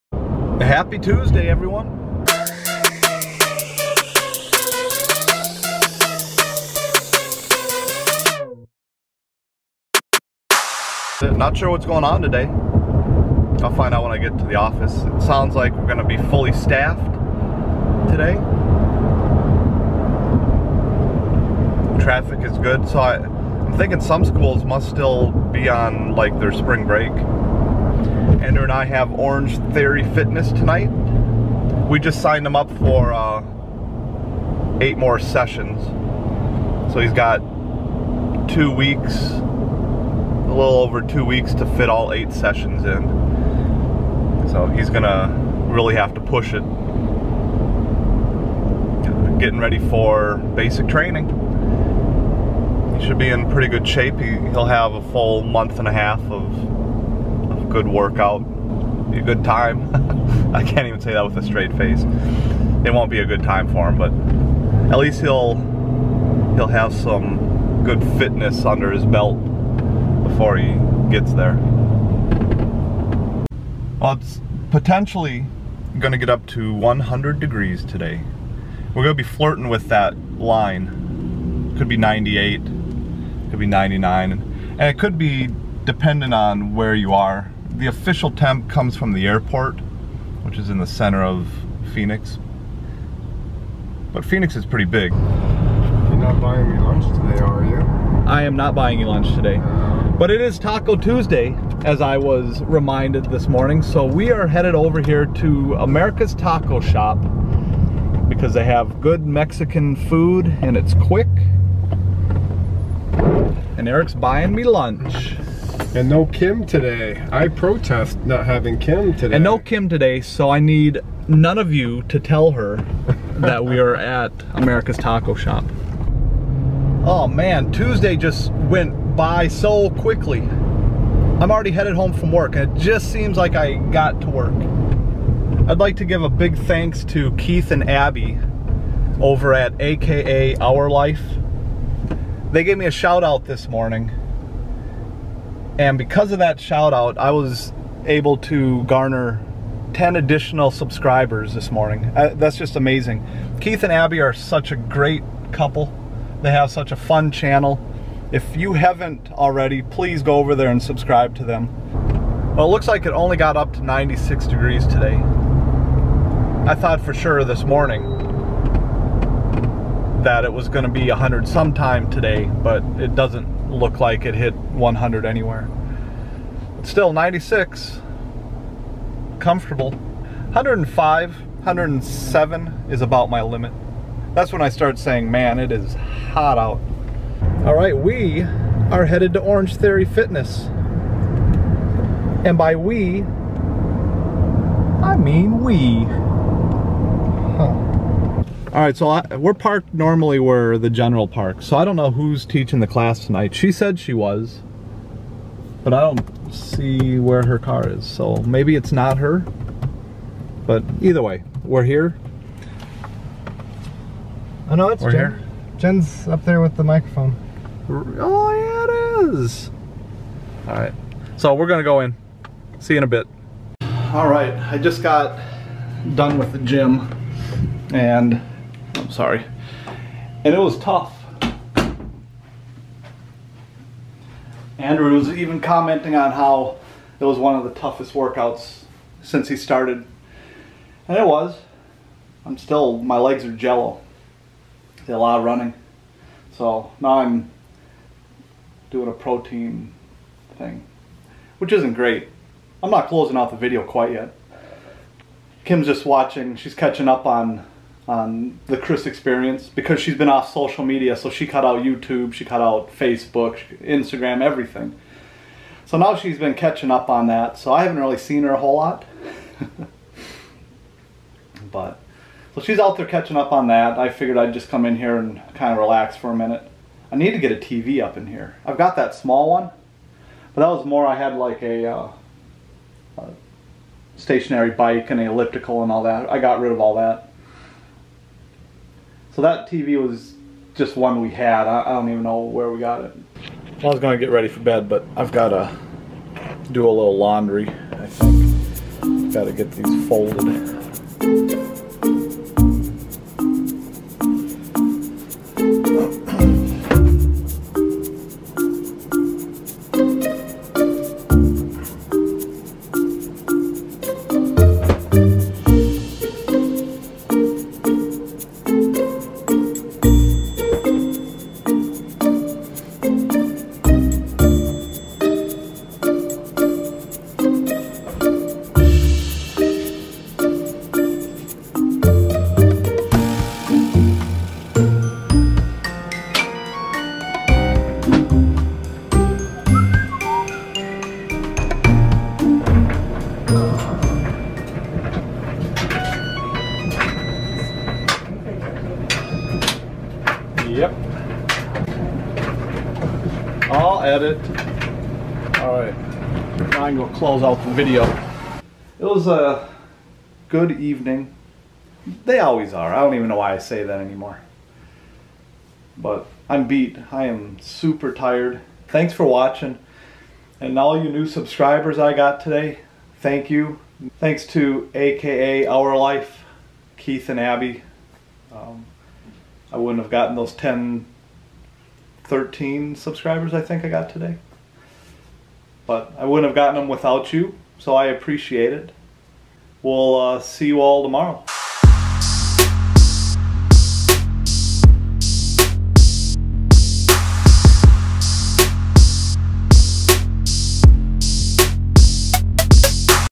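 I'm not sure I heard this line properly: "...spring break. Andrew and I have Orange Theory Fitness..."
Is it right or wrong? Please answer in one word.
right.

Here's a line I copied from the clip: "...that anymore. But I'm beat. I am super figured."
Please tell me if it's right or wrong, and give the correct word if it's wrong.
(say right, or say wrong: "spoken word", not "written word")
wrong: "tired", not "figured".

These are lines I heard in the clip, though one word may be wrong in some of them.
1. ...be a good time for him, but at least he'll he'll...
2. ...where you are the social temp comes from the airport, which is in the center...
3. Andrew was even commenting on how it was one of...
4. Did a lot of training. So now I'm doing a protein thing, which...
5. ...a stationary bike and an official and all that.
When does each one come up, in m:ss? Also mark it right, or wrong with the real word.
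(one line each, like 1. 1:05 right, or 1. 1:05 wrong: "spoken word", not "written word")
1. 1:03 right
2. 1:26 wrong: "official", not "social"
3. 3:54 right
4. 4:05 wrong: "running", not "training"
5. 4:43 wrong: "elliptical", not "official".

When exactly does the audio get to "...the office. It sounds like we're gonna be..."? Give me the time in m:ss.
0:14.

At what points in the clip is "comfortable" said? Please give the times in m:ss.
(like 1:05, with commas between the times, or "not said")
2:59.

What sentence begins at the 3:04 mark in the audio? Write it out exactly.
That's when I start saying, man, it is hot out.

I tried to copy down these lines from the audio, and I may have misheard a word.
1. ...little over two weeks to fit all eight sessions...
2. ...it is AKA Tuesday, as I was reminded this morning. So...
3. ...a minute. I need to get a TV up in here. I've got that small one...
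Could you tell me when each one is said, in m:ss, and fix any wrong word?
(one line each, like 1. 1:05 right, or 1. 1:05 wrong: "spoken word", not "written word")
1. 0:40 right
2. 1:40 wrong: "Taco", not "AKA"
3. 4:36 right.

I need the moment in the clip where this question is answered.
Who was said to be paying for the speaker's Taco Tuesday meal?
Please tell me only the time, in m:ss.
1:53.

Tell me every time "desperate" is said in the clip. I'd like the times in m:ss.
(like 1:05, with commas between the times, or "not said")
not said.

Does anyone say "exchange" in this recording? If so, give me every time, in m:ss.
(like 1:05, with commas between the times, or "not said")
not said.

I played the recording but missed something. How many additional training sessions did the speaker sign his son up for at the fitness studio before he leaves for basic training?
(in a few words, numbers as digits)
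8.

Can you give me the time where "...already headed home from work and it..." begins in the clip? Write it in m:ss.
2:11.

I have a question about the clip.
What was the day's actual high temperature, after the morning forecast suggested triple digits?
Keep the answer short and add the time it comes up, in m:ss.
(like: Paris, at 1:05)
96 degrees, at 2:43.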